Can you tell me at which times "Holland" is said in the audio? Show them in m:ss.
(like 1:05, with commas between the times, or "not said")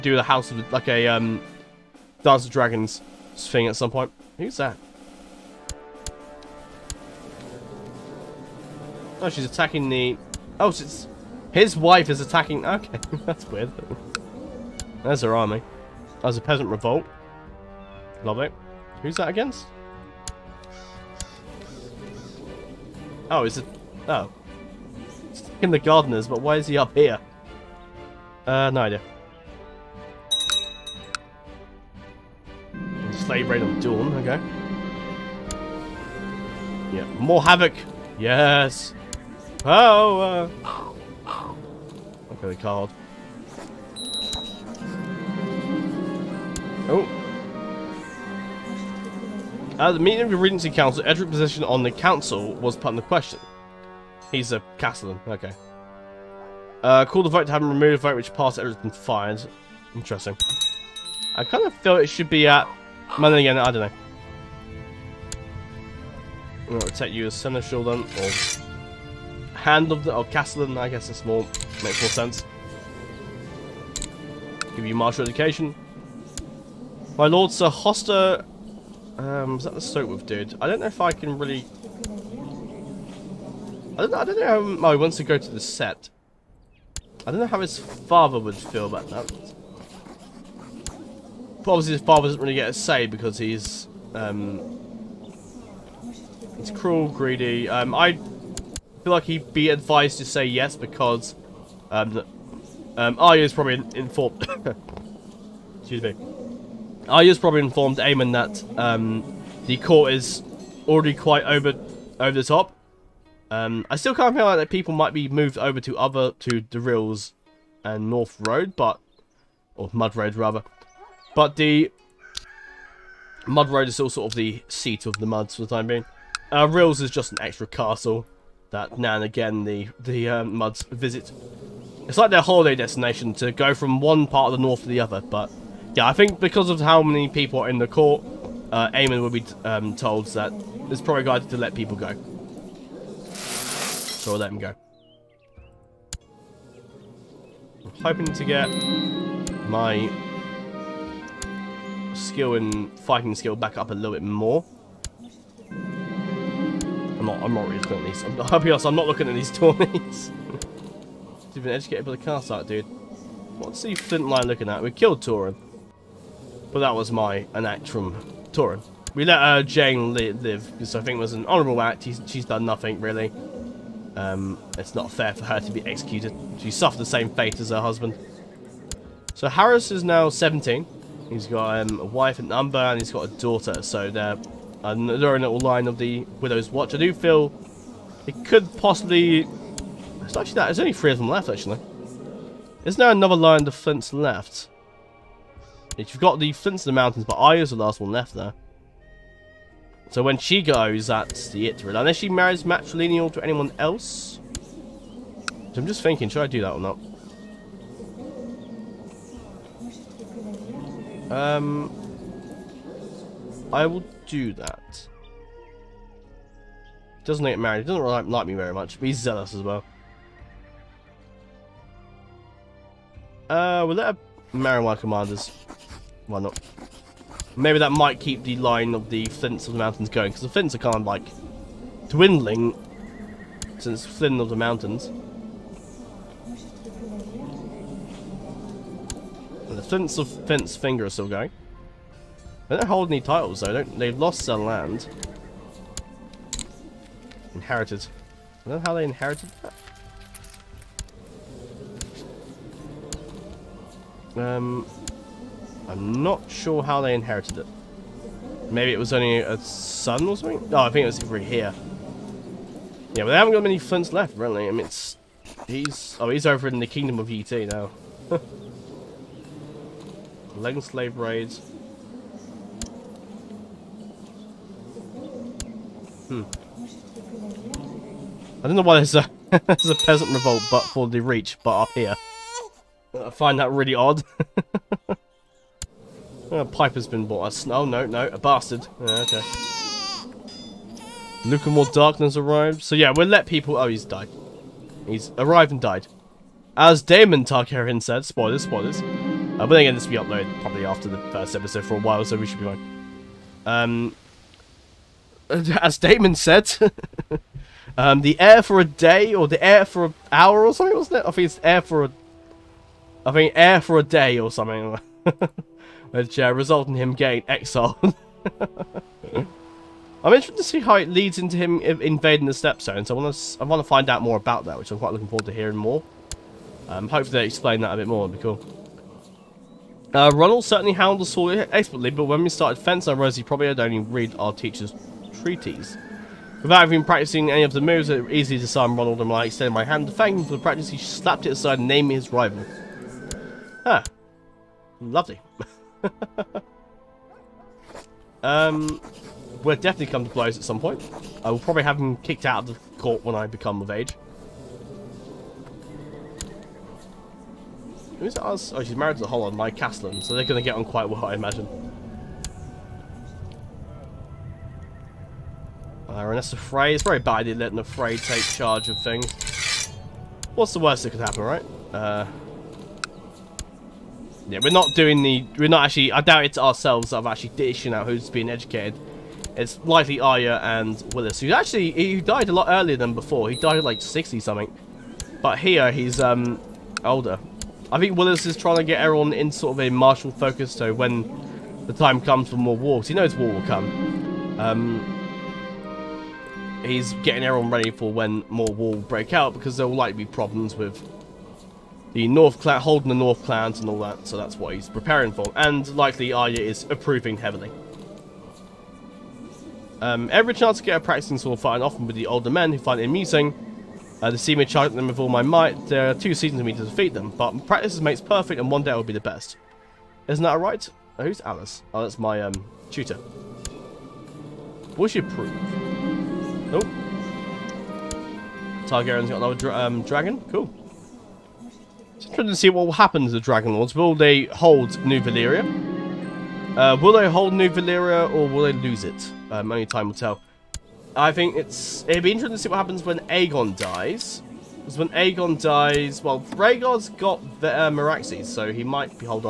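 5:59.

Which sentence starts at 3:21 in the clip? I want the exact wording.
Unless she marries matrilineal to anyone else.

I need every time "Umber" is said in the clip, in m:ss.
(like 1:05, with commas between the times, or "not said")
3:02.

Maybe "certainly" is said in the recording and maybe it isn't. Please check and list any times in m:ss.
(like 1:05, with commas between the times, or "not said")
5:30.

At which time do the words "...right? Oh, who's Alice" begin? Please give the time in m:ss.
7:00.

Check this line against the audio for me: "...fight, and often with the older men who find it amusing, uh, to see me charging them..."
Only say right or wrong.
right.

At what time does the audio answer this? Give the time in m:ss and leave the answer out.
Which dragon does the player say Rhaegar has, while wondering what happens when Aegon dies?
7:27.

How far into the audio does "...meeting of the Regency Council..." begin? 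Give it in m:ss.
0:49.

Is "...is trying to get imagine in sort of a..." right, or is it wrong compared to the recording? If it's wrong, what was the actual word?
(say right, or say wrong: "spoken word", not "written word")
wrong: "everyone", not "imagine".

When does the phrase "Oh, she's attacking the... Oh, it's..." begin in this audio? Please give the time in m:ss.
0:09.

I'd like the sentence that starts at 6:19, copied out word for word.
It's likely Arya and Willis, who actually, he died a lot earlier than before.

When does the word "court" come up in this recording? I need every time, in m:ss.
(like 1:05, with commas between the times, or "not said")
1:49, 2:17, 5:53.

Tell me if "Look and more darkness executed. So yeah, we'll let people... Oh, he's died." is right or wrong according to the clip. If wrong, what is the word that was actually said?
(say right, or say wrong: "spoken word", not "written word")
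wrong: "arrived", not "executed".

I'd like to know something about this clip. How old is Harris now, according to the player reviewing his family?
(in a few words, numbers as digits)
17.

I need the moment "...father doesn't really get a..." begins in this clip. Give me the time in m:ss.
1:32.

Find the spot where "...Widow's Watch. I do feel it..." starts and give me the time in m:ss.
3:06.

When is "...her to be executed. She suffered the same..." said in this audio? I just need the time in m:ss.
2:55.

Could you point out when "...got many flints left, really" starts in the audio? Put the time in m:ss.
4:23.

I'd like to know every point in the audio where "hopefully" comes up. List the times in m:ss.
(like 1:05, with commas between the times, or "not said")
5:27.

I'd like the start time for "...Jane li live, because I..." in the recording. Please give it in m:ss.
2:49.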